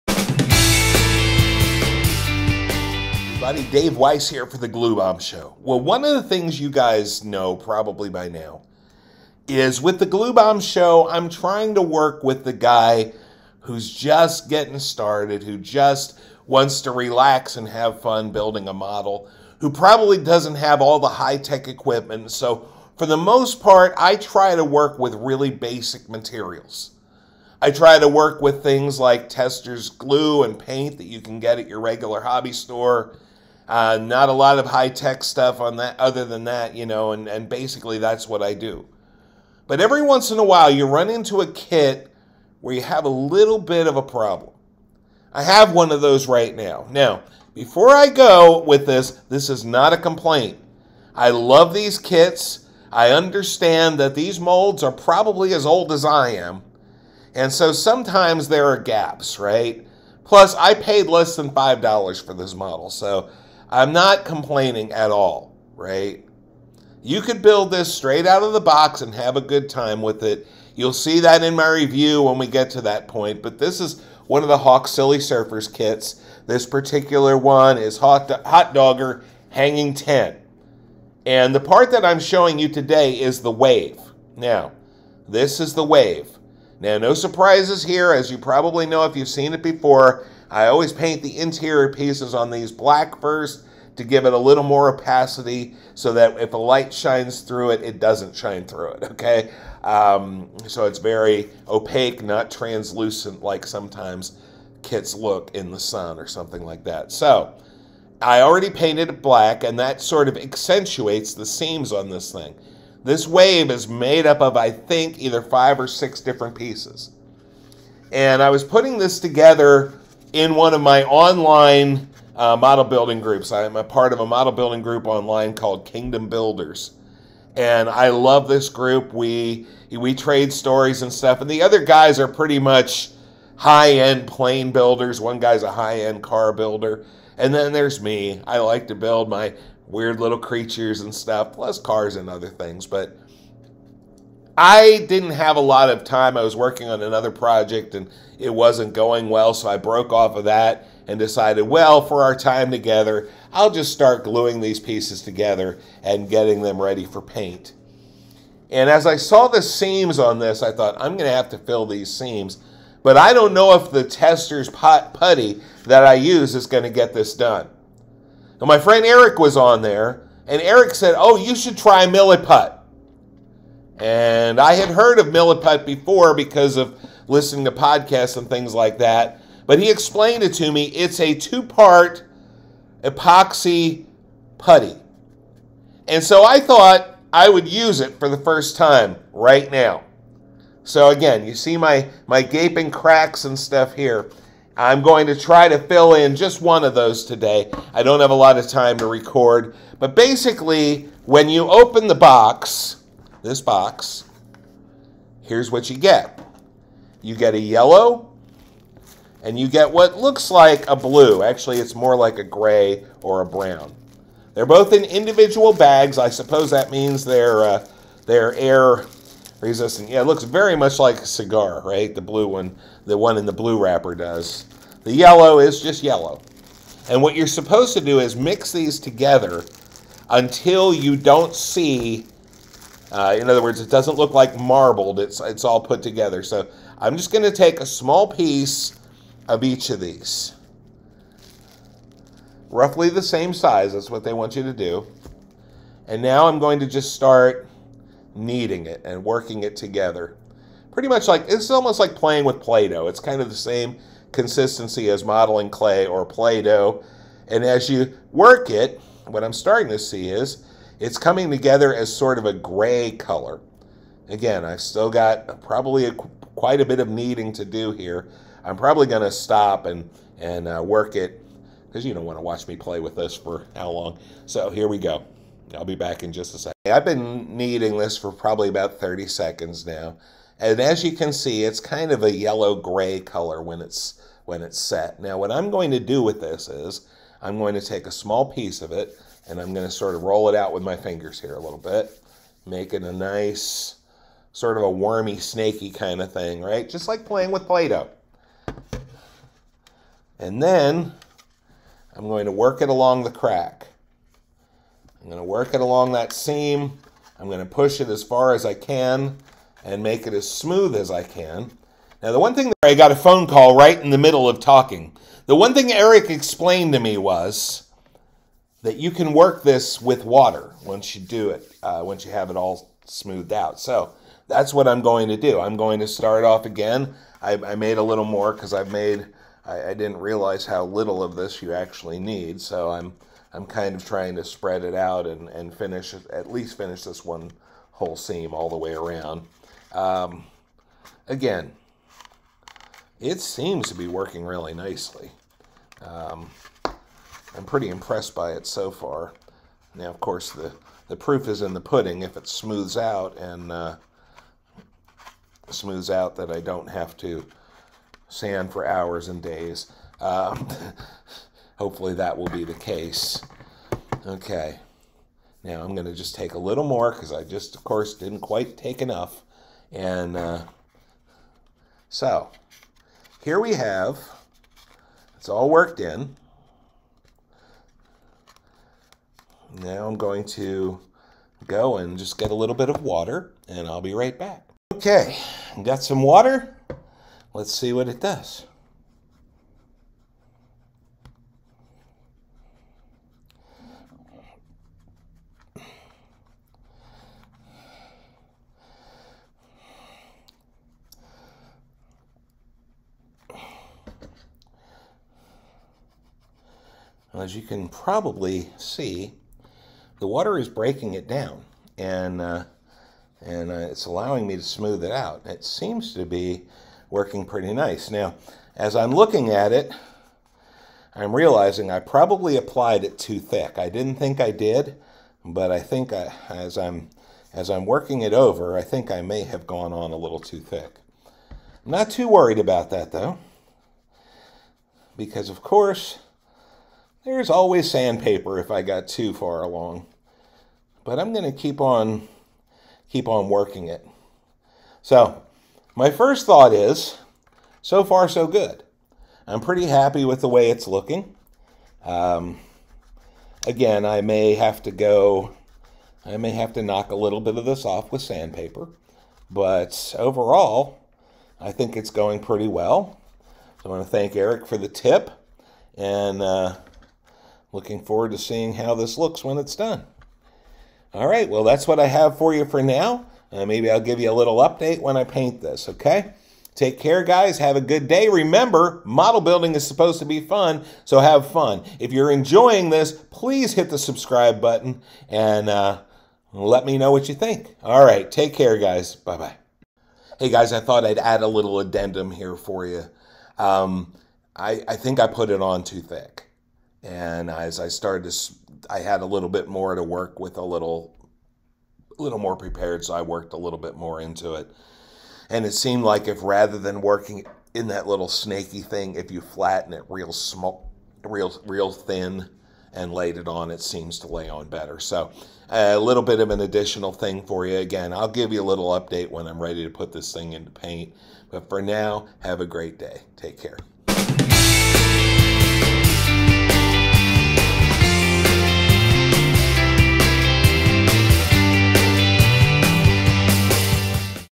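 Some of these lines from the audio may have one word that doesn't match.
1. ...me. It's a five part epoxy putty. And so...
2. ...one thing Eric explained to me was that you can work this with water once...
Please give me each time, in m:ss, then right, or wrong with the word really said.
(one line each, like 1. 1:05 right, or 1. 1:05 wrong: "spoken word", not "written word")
1. 3:00 wrong: "two", not "five"
2. 5:15 right.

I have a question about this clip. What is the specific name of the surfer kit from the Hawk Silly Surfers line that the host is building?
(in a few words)
Hot Dogger Hanging 10.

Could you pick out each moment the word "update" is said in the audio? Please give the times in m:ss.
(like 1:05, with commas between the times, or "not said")
7:54, 8:38.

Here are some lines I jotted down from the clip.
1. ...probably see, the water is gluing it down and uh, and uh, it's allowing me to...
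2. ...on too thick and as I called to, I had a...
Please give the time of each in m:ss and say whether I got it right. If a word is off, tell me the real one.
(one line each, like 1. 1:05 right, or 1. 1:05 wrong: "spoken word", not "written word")
1. 6:47 wrong: "breaking", not "gluing"
2. 8:15 wrong: "started", not "called".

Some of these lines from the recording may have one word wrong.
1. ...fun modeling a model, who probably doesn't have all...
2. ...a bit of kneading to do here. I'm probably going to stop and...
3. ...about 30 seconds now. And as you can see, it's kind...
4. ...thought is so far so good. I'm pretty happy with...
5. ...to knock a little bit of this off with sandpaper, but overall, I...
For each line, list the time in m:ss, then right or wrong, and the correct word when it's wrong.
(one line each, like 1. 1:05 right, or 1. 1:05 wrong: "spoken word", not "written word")
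1. 0:18 wrong: "building", not "modeling"
2. 4:26 right
3. 4:38 right
4. 7:26 right
5. 7:36 right.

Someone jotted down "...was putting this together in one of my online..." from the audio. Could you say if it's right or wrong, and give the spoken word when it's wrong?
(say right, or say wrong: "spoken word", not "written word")
right.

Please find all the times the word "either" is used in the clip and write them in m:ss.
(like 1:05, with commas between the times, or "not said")
1:55.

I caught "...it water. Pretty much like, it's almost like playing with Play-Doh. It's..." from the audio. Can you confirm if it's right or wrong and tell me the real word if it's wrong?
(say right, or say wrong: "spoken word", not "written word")
wrong: "together", not "water".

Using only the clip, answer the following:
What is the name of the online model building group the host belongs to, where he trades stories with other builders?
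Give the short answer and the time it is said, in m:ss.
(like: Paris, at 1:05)
Kingdom Builders, at 2:05.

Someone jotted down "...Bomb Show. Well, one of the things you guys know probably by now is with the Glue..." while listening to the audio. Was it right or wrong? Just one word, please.
right.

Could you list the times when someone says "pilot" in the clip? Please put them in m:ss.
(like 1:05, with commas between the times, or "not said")
not said.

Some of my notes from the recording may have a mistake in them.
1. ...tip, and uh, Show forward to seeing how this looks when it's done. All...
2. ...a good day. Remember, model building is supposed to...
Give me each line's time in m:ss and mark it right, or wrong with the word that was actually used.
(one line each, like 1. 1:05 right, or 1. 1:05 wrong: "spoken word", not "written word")
1. 7:44 wrong: "Looking", not "Show"
2. 7:57 right.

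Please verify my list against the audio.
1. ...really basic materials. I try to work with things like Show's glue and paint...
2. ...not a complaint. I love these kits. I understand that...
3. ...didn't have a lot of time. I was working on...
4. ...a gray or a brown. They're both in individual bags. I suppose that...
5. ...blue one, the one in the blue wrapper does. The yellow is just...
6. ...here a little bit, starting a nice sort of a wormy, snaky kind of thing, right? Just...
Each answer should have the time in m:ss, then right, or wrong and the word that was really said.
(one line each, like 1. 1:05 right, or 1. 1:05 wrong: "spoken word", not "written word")
1. 0:25 wrong: "Testor", not "Show"
2. 0:49 right
3. 2:25 right
4. 3:32 right
5. 3:42 right
6. 4:51 wrong: "making", not "starting".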